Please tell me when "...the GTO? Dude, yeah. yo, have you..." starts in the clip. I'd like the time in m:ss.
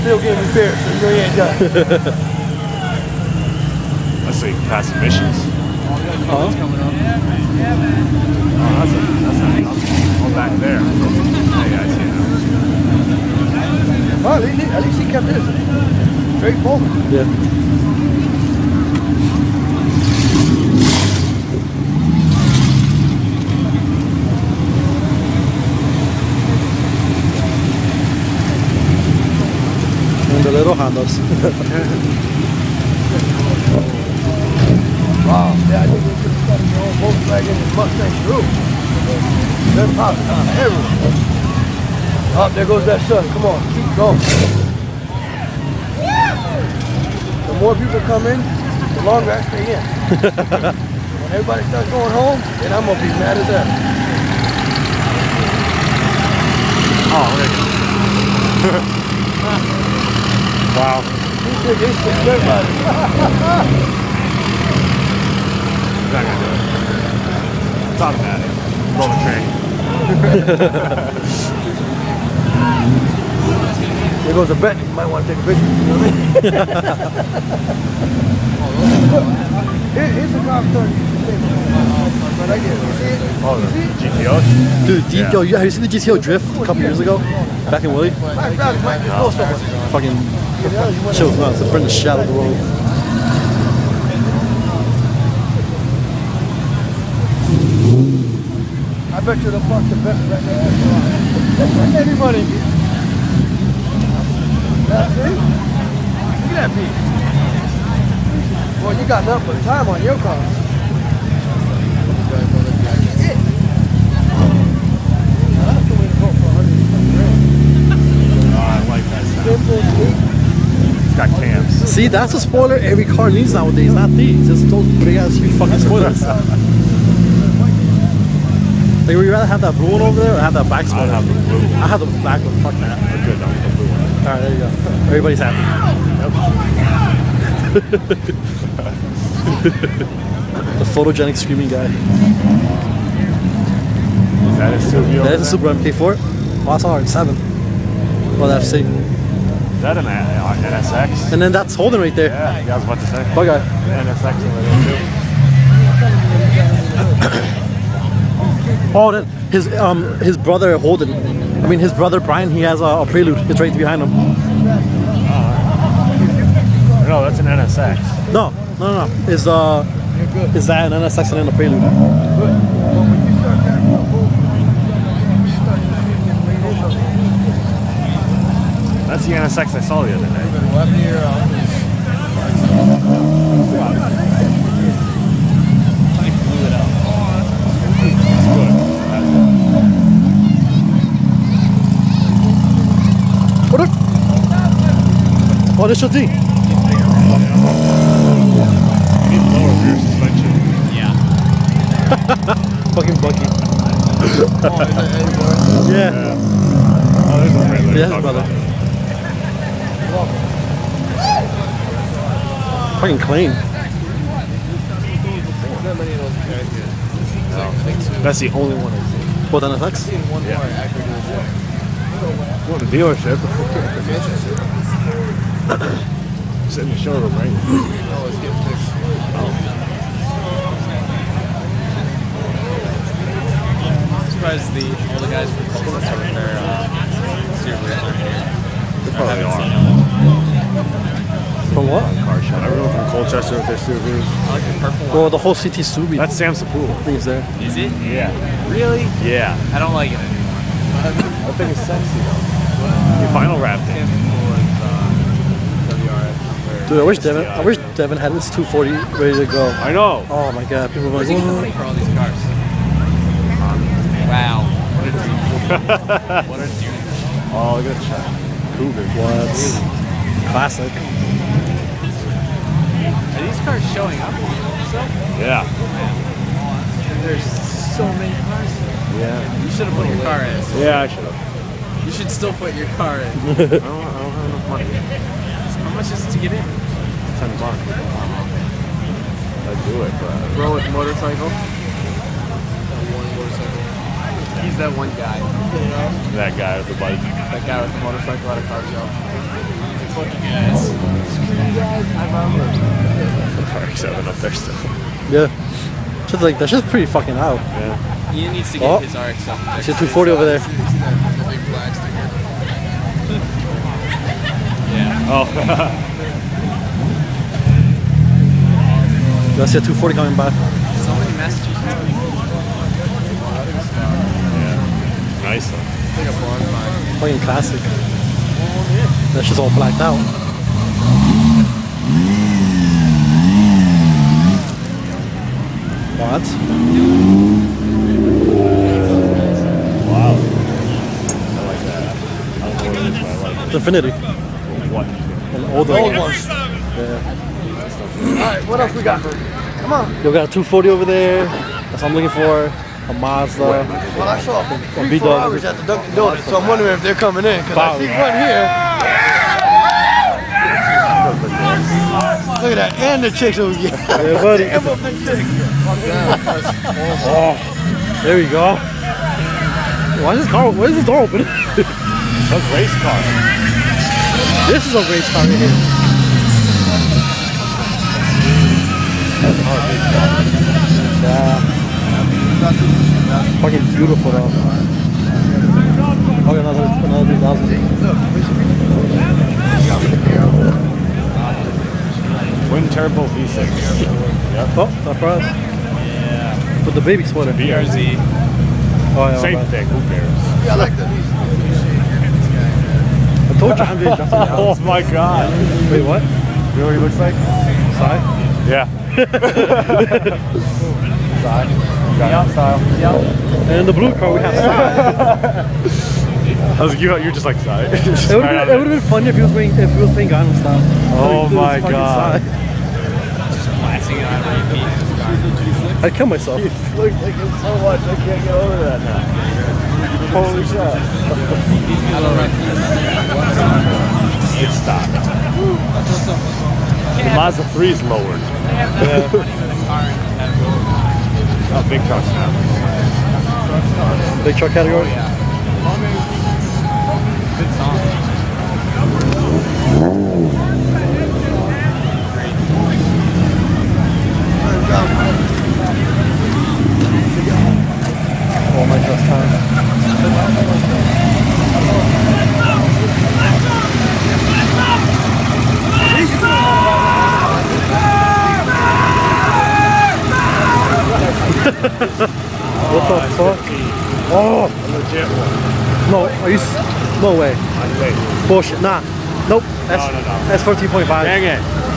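1:23.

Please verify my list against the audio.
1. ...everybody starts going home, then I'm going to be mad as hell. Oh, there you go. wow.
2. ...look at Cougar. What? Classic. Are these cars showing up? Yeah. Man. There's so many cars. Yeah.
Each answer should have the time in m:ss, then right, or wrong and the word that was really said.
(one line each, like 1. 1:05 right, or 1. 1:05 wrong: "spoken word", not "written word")
1. 0:51 right
2. 4:27 right.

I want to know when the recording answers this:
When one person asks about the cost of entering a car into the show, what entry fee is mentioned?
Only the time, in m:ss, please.
4:47.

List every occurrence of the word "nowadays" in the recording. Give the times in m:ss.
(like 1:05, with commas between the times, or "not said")
2:03.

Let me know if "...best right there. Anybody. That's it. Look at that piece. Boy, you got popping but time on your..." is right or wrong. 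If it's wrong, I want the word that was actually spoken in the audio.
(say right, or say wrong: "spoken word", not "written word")
wrong: "nothing", not "popping".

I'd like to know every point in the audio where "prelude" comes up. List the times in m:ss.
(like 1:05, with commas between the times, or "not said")
2:43, 2:51.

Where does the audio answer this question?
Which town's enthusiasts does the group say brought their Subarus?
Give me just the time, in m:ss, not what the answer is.
4:03.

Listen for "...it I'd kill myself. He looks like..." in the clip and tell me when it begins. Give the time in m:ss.
7:04.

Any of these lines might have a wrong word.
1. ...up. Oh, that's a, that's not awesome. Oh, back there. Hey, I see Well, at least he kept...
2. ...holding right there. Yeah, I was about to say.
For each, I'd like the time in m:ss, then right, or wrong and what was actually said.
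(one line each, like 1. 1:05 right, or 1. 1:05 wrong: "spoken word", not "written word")
1. 0:06 right
2. 2:31 right.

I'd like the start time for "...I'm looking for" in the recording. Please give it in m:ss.
5:52.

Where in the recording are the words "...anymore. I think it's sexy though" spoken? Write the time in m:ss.
4:10.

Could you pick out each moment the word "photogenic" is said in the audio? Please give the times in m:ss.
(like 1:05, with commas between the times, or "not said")
2:20.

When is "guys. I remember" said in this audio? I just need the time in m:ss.
5:01.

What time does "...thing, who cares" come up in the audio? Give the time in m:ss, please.
6:39.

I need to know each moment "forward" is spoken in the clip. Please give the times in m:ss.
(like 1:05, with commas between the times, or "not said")
0:16.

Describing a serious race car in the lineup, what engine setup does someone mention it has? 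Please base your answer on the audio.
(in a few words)
Twin turbo V6.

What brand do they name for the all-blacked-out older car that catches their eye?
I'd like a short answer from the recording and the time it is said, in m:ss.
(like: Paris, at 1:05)
Infiniti, at 5:44.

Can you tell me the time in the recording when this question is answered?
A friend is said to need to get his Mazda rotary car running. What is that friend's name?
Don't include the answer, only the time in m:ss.
5:08.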